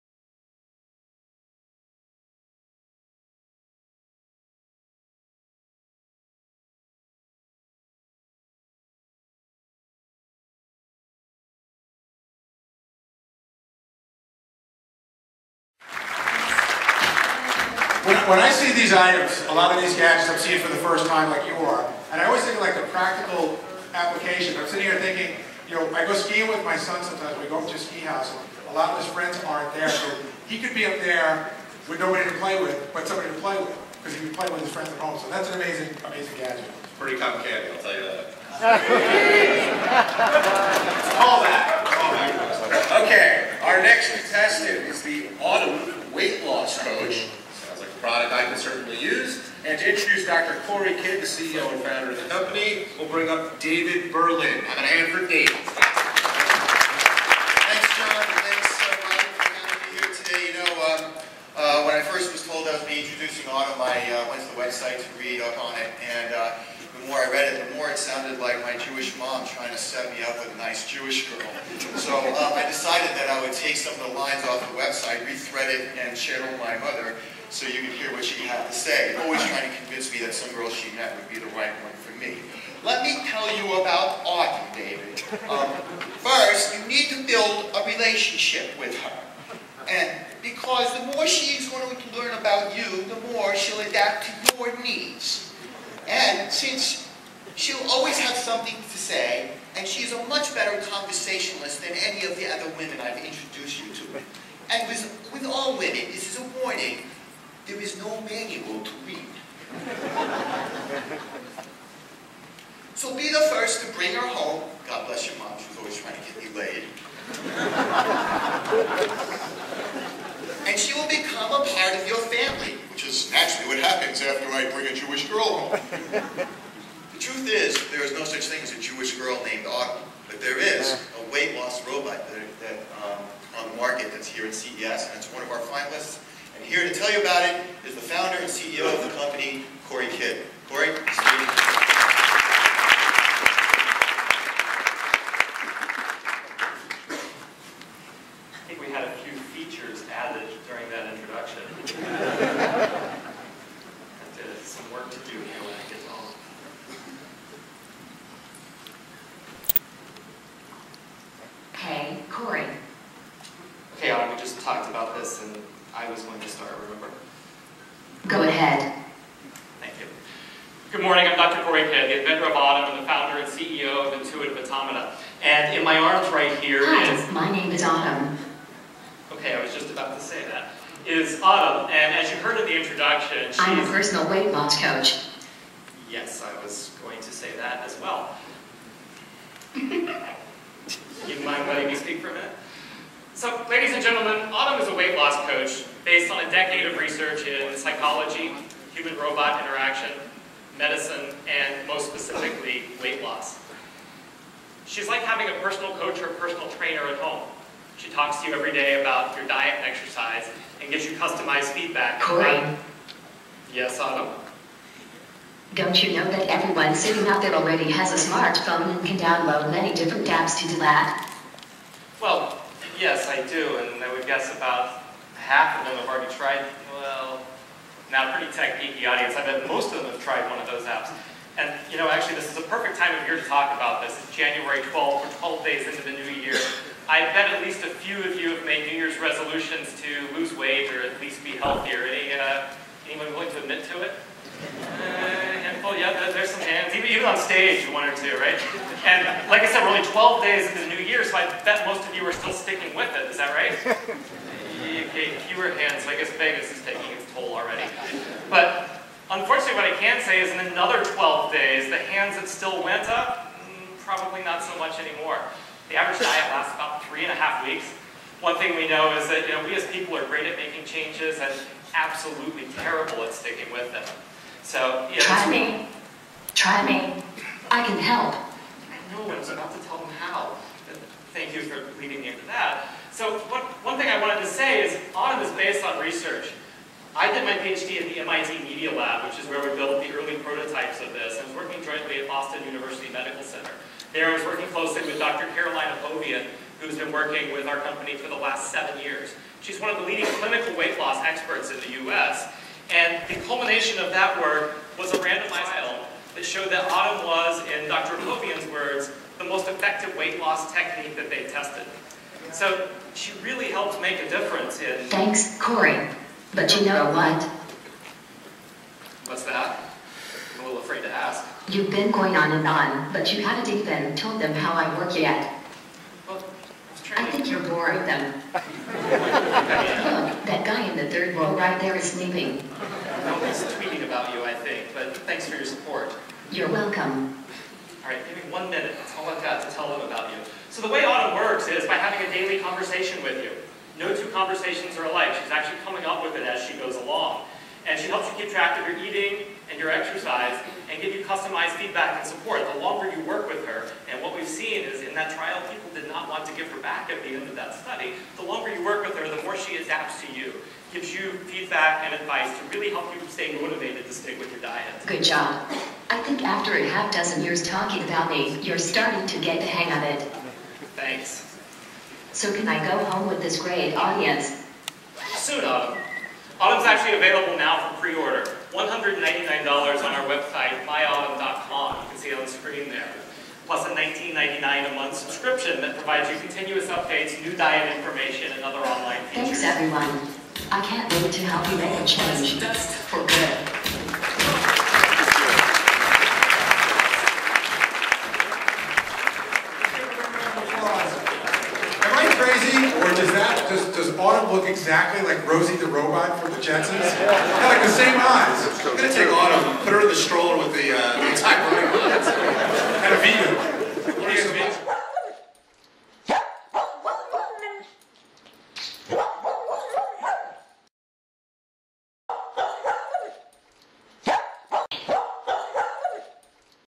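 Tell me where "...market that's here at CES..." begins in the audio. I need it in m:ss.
2:13.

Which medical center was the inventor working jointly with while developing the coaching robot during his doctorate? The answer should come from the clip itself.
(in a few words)
Boston University Medical Center.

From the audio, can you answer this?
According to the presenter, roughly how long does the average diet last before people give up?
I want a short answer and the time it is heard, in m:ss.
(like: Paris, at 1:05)
three and a half weeks, at 4:27.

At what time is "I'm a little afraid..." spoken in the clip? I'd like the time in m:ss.
5:20.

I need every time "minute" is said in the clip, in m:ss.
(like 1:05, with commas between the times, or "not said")
3:12, 5:38.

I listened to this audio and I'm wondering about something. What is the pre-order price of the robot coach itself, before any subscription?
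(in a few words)
$199.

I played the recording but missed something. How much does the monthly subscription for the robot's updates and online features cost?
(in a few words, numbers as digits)
$19.99.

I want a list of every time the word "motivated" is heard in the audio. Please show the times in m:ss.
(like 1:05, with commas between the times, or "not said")
6:03.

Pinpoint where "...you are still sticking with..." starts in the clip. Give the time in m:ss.
4:12.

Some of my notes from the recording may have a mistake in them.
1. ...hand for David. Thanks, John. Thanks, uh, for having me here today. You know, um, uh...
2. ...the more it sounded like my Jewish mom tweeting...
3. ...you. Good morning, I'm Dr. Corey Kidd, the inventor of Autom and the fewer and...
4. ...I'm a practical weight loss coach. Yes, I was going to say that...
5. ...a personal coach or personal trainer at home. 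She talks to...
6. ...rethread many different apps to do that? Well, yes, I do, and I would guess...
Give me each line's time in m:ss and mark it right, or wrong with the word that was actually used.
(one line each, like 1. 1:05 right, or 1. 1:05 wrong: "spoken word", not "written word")
1. 0:54 right
2. 1:07 wrong: "trying", not "tweeting"
3. 2:49 wrong: "founder", not "fewer"
4. 3:03 wrong: "personal", not "practical"
5. 3:25 right
6. 3:39 wrong: "download", not "rethread".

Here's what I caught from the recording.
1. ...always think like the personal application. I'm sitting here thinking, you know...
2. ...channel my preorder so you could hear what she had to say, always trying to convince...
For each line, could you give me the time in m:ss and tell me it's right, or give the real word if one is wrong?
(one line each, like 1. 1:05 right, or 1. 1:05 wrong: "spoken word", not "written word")
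1. 0:22 wrong: "practical", not "personal"
2. 1:16 wrong: "mother", not "preorder".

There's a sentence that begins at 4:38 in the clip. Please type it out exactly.
I know, I was about to tell them how.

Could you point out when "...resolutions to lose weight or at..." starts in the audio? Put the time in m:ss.
3:59.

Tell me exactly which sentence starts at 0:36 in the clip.
It's pretty complicated, I'll tell you that.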